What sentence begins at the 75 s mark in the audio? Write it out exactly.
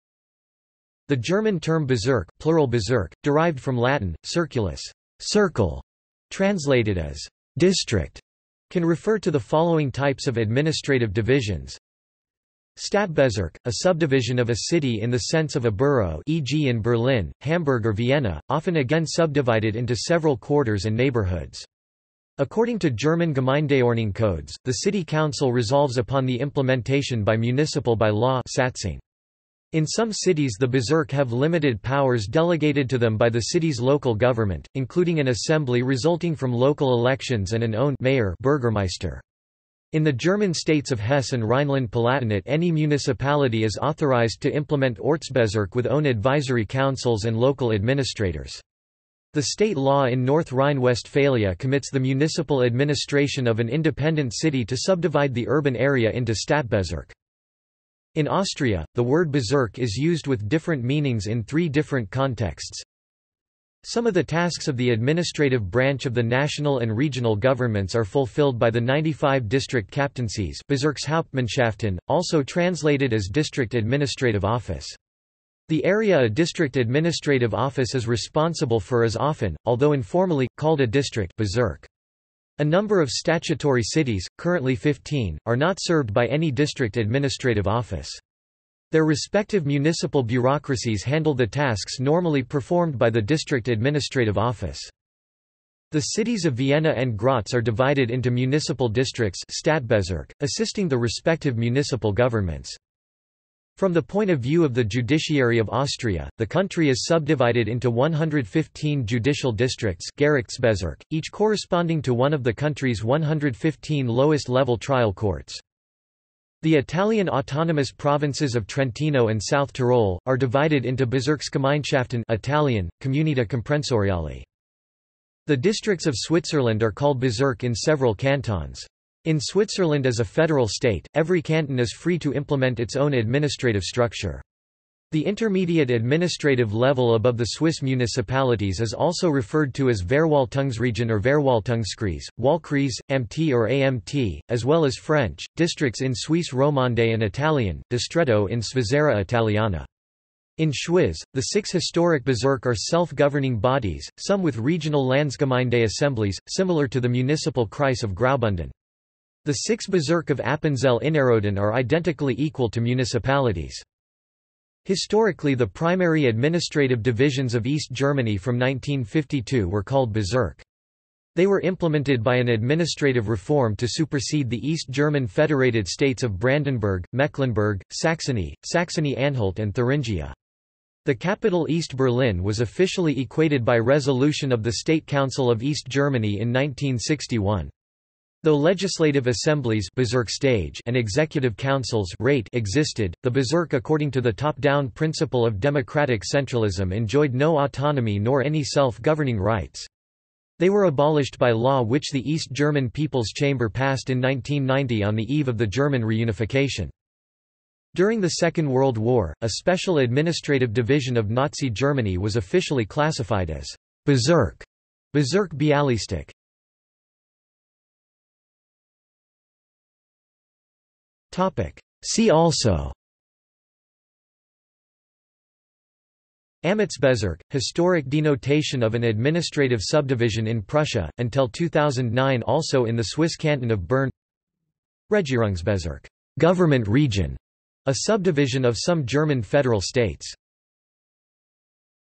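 The area a district administrative office is responsible for is often, although informally, called a district Bezirk.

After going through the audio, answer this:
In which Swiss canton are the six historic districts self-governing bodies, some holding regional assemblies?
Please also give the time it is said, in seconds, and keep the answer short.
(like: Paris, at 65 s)
Schwyz, at 150 s.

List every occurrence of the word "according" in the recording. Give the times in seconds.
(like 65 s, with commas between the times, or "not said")
22 s, 193 s.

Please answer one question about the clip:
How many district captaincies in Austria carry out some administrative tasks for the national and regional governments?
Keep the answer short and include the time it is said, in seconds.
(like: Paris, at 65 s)
95, at 68 s.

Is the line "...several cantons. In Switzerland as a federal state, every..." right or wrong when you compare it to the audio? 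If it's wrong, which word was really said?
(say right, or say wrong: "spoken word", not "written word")
right.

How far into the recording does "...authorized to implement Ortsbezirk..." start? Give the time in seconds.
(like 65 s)
43 s.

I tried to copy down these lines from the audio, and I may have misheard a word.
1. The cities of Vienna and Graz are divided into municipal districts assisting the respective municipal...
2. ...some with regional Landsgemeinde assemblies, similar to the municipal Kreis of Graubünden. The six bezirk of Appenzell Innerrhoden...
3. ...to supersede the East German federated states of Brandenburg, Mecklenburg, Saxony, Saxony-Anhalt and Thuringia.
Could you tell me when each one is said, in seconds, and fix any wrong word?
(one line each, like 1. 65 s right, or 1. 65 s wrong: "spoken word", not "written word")
1. 95 s right
2. 154 s right
3. 173 s right.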